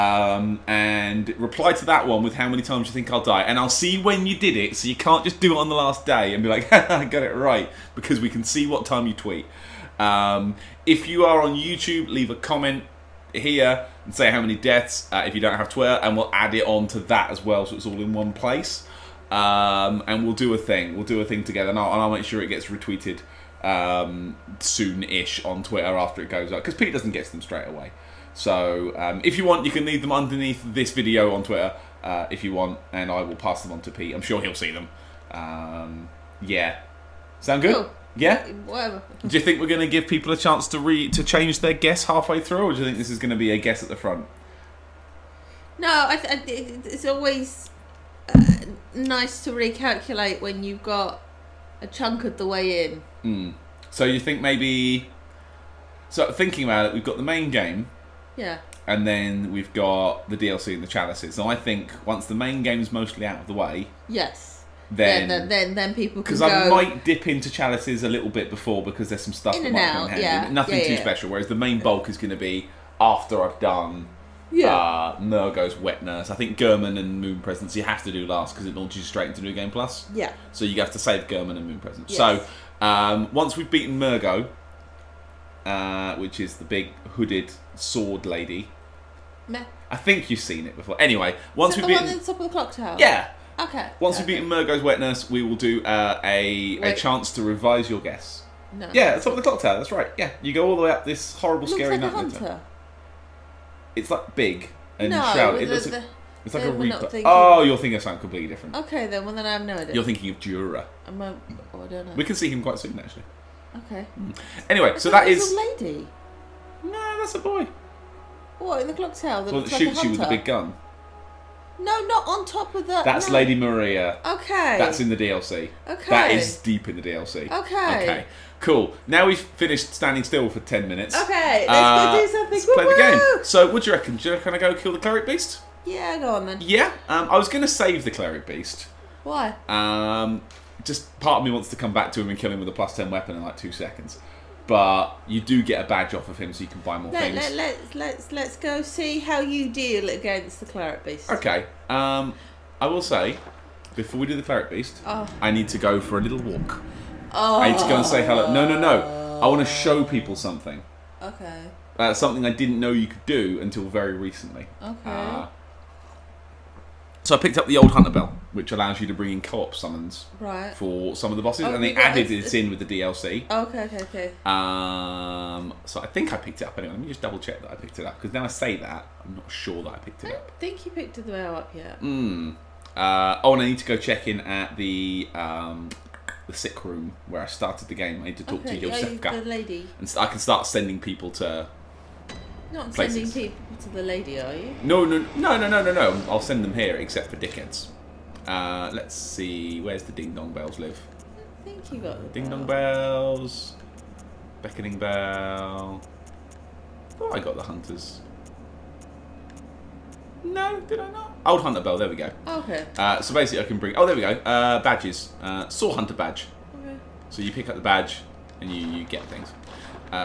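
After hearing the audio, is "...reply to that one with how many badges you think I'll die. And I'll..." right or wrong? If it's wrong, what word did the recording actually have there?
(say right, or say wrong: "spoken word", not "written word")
wrong: "times", not "badges".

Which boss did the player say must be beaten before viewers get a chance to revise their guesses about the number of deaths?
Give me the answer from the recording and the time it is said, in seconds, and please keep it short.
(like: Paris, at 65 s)
Mergo's Wet Nurse, at 94 s.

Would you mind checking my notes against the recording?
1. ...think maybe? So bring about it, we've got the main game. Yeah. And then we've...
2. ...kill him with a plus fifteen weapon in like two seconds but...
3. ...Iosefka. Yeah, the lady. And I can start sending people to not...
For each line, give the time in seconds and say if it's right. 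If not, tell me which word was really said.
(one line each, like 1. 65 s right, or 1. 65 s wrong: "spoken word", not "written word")
1. 54 s wrong: "thinking", not "bring"
2. 142 s wrong: "ten", not "fifteen"
3. 188 s right.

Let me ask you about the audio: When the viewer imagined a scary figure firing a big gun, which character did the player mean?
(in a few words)
Djura.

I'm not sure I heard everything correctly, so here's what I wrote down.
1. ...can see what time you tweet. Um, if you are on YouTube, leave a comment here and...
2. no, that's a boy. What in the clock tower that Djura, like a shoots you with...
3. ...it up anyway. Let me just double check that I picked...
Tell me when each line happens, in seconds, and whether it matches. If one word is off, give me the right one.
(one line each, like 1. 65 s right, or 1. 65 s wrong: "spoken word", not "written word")
1. 8 s right
2. 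116 s wrong: "Well", not "Djura"
3. 176 s right.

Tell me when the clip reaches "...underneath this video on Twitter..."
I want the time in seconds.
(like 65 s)
30 s.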